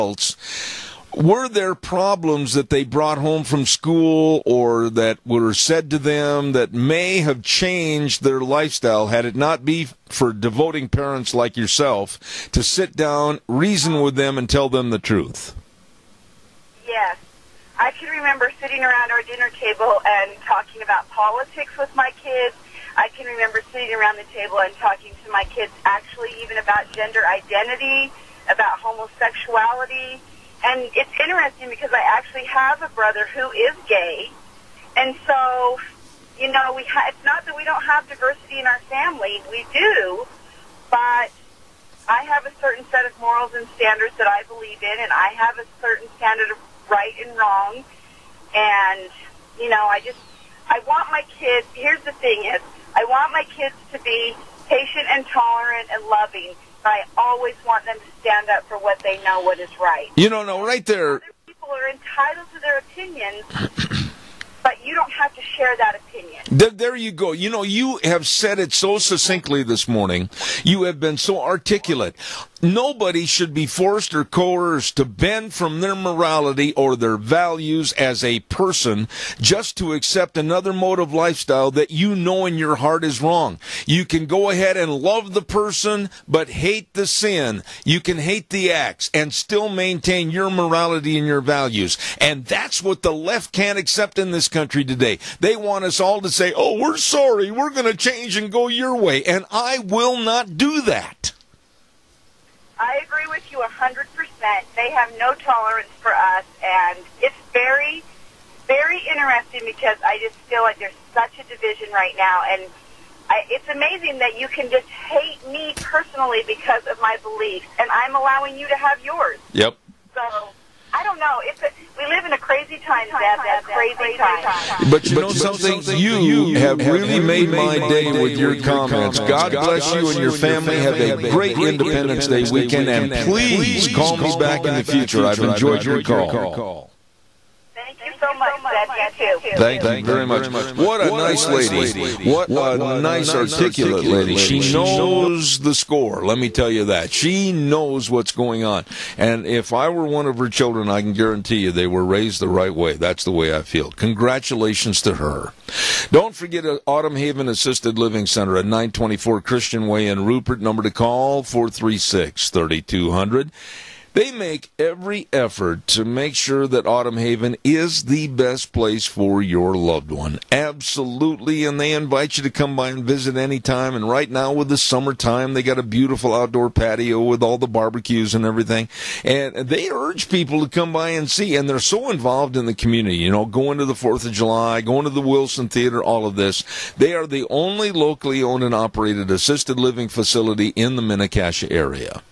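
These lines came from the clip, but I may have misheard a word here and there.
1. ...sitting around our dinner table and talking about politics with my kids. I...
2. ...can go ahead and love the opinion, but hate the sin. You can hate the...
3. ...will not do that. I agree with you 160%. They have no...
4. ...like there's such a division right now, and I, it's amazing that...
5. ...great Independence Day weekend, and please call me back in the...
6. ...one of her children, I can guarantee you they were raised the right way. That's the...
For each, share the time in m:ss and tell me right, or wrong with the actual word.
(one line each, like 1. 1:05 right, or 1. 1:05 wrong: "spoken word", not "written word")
1. 0:18 right
2. 1:24 wrong: "person", not "opinion"
3. 1:39 wrong: "100", not "160"
4. 1:50 right
5. 2:11 right
6. 2:30 right.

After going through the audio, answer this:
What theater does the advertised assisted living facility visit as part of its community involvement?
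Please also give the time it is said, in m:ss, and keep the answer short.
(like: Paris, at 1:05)
Wilson Theater, at 3:05.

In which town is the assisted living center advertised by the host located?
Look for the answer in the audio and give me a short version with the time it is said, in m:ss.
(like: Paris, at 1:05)
Rupert, at 2:40.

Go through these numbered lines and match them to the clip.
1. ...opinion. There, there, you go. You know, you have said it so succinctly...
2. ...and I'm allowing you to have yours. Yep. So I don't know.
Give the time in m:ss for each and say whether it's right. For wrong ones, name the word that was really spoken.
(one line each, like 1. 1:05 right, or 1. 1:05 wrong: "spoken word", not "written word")
1. 1:05 right
2. 1:57 right.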